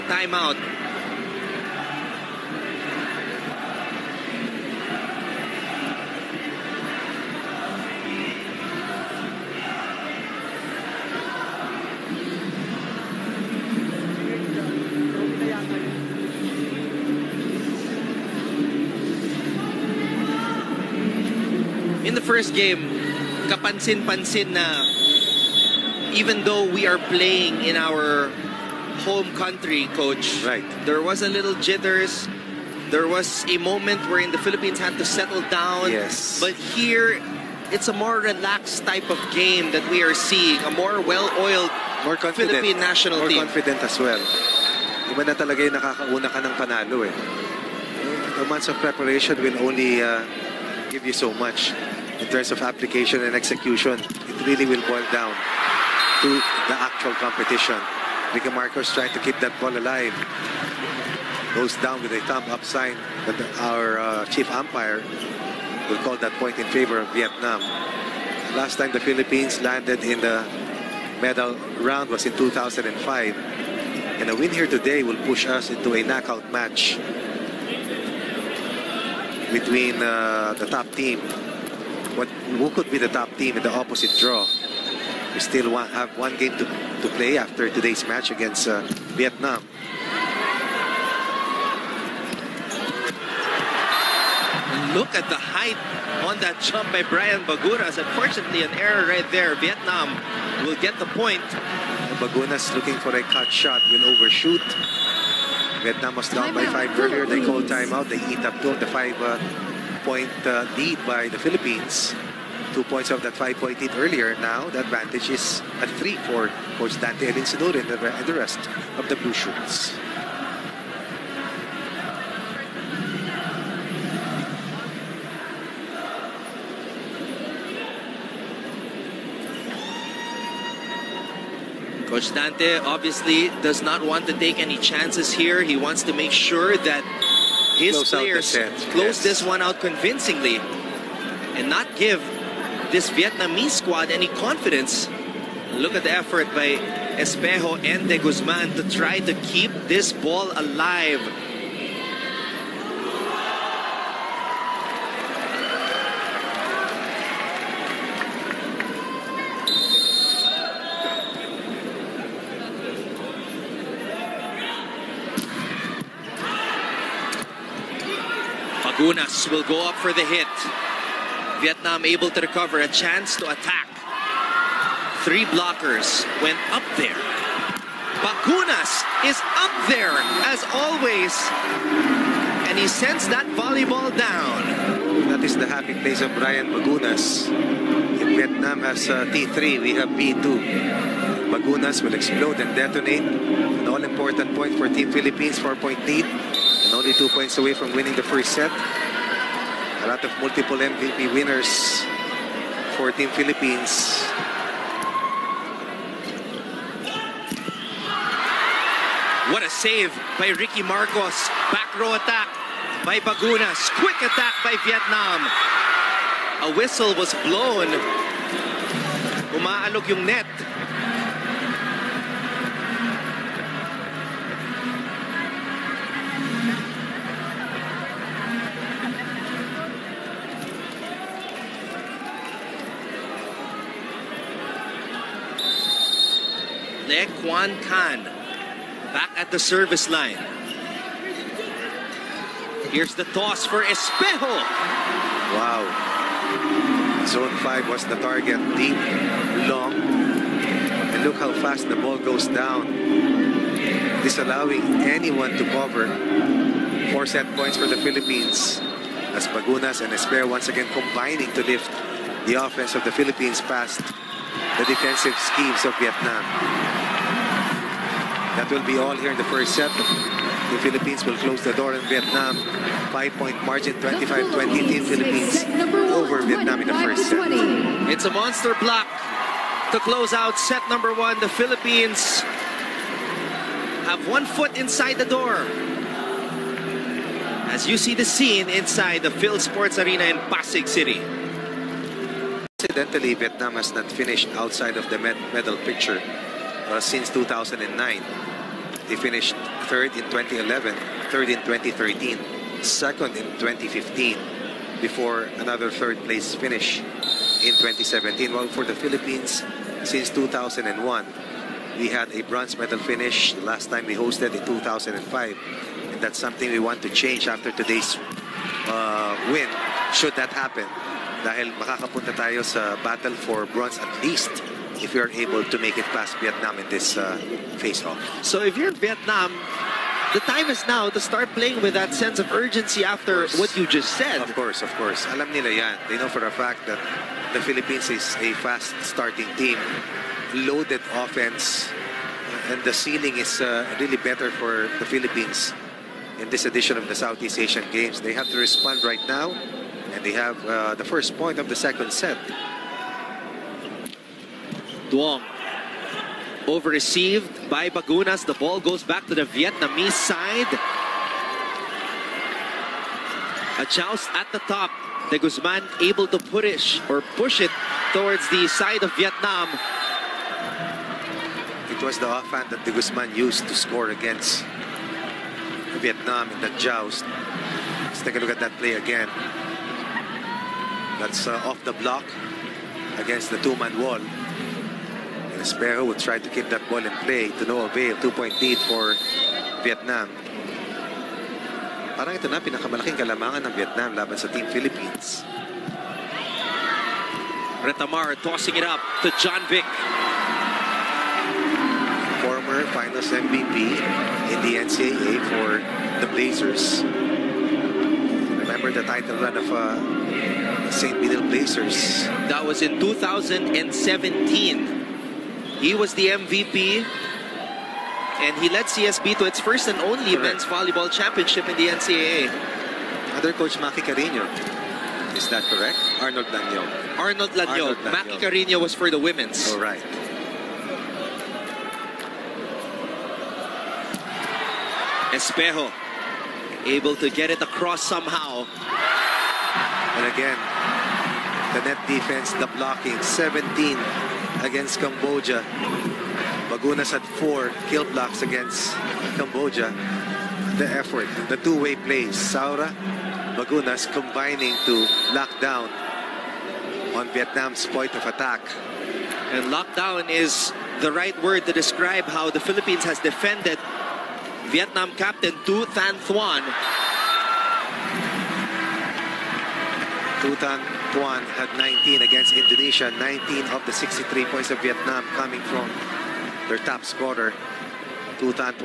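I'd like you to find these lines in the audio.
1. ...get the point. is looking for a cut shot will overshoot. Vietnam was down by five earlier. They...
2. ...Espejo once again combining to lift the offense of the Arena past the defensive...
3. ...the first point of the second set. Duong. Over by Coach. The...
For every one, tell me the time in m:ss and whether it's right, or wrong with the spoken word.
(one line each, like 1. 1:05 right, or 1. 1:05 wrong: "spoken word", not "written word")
1. 1:40 right
2. 4:20 wrong: "Philippines", not "Arena"
3. 5:50 wrong: "Bagunas", not "Coach".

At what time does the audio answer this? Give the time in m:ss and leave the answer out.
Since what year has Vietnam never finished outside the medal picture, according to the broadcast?
4:57.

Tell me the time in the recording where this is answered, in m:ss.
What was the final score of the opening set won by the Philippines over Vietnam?
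4:33.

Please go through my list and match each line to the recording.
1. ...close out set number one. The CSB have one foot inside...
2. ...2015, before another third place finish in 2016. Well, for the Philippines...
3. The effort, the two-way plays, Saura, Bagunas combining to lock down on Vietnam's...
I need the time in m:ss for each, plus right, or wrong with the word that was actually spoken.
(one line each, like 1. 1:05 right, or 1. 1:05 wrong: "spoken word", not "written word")
1. 4:39 wrong: "Philippines", not "CSB"
2. 5:03 wrong: "2017", not "2016"
3. 7:30 right.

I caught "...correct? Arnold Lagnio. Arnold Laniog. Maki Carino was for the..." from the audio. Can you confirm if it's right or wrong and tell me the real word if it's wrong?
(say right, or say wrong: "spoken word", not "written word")
right.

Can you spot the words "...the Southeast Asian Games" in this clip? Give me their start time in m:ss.
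5:47.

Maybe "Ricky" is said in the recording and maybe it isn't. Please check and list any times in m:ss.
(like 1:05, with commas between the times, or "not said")
0:58, 3:30.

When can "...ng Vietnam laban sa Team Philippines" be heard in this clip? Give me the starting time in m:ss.
6:33.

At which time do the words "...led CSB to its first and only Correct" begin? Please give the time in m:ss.
6:58.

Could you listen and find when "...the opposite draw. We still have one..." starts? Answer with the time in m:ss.
1:23.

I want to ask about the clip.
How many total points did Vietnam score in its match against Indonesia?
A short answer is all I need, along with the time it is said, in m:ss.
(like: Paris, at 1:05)
63, at 7:53.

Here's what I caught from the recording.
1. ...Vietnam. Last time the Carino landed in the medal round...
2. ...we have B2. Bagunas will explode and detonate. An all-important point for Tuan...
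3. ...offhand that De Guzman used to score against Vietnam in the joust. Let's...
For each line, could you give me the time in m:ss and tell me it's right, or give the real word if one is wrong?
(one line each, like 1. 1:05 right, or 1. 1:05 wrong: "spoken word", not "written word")
1. 1:07 wrong: "Philippines", not "Carino"
2. 3:09 wrong: "Team", not "Tuan"
3. 6:12 right.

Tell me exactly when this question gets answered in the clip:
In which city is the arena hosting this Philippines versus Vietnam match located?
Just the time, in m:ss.
4:50.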